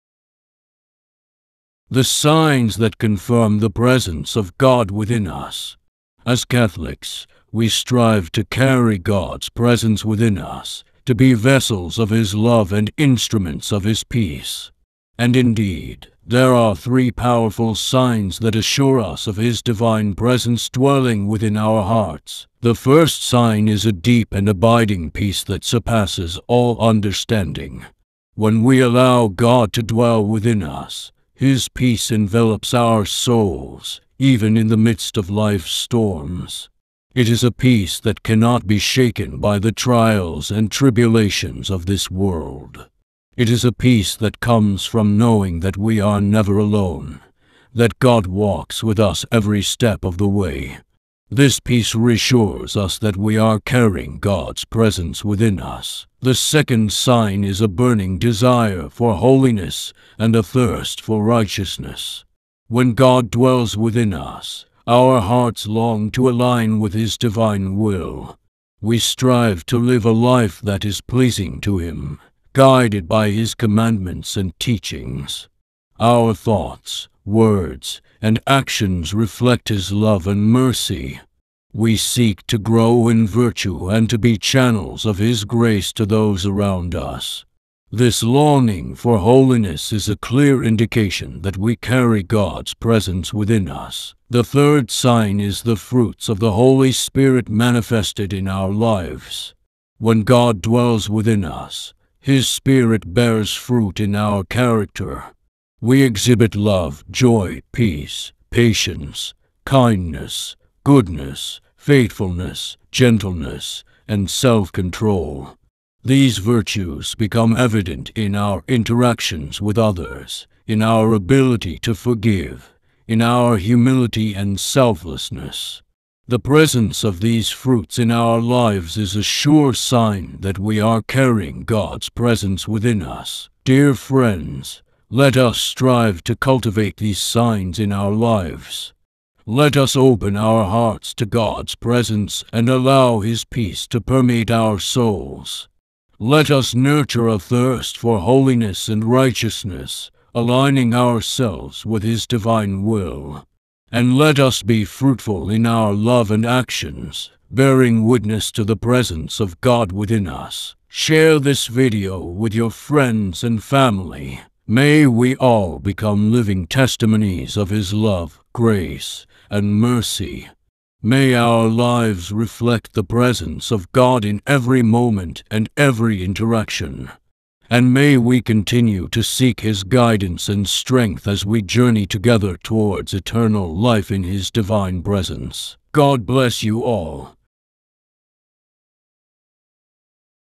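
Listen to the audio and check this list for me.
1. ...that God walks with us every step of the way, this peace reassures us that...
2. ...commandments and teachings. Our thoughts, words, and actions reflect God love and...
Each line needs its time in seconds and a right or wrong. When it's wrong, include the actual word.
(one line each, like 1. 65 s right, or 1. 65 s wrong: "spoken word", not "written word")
1. 47 s right
2. 73 s wrong: "His", not "God".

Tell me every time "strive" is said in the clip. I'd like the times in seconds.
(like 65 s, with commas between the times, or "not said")
7 s, 68 s, 135 s.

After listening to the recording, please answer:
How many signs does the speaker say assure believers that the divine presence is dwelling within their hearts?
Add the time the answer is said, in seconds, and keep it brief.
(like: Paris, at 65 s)
3, at 16 s.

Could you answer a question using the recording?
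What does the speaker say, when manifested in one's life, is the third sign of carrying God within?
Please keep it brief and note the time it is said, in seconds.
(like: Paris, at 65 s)
Fruits of the Holy Spirit, at 95 s.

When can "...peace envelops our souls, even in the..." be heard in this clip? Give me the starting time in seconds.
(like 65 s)
31 s.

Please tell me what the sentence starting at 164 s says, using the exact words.
May we all become living testimonies of His love, grace, and mercy.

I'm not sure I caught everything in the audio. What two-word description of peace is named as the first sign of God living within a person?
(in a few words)
Deep and abiding peace.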